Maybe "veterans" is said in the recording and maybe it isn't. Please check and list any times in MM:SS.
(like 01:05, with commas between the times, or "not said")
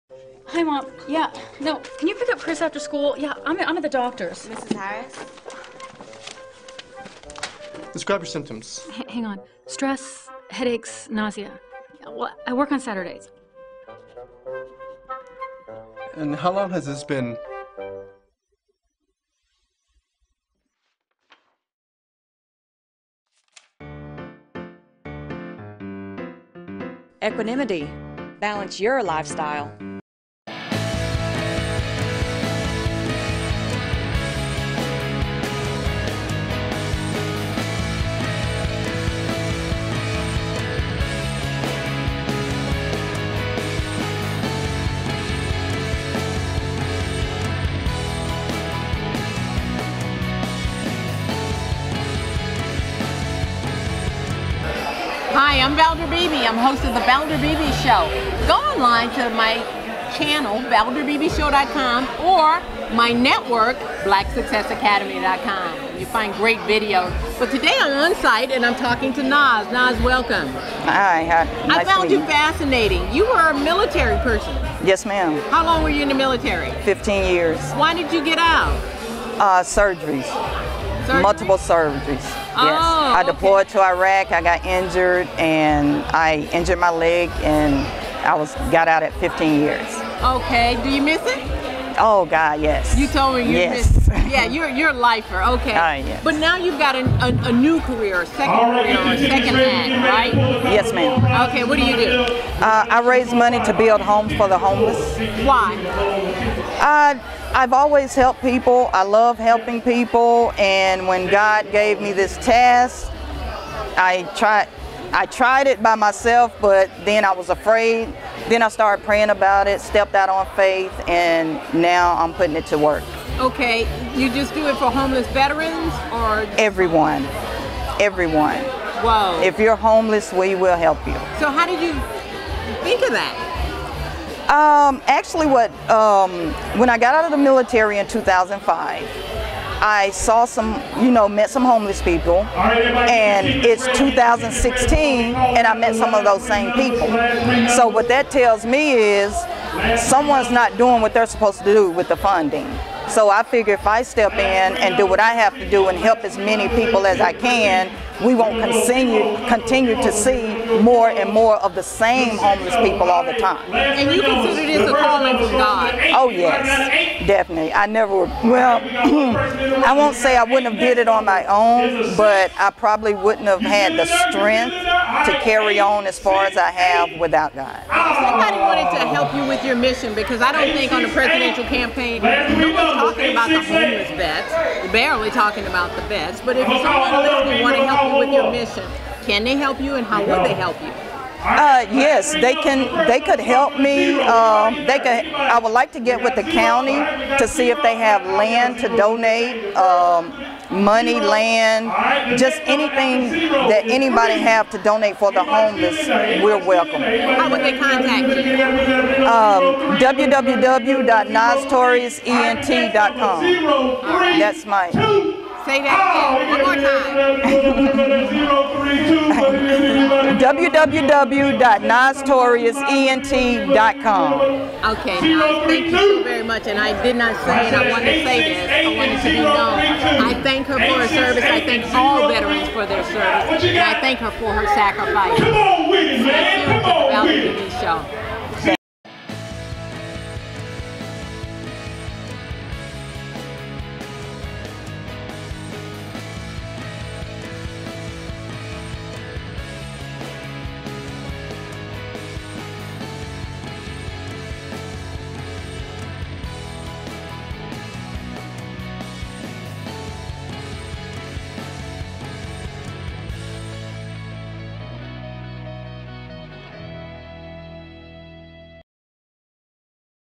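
02:05, 03:52.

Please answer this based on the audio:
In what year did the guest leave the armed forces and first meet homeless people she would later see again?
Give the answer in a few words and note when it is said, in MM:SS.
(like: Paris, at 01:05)
2005, at 02:18.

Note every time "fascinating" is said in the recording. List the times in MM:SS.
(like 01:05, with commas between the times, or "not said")
01:12.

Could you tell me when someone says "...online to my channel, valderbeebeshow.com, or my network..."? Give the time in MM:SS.
00:58.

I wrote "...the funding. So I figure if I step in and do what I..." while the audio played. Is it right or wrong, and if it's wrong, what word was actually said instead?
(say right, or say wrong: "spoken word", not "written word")
right.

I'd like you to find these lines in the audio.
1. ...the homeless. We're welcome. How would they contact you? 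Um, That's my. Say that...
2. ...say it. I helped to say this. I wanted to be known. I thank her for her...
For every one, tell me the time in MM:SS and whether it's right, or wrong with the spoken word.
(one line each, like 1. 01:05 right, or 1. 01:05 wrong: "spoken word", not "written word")
1. 03:25 right
2. 03:47 wrong: "wanted", not "helped".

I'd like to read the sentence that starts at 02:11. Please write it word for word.
So how did you think of that?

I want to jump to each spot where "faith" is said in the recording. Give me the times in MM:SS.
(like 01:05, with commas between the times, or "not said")
02:00.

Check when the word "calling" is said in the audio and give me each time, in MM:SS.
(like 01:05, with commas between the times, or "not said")
02:44.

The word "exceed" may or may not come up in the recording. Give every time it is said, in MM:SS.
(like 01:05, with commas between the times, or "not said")
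not said.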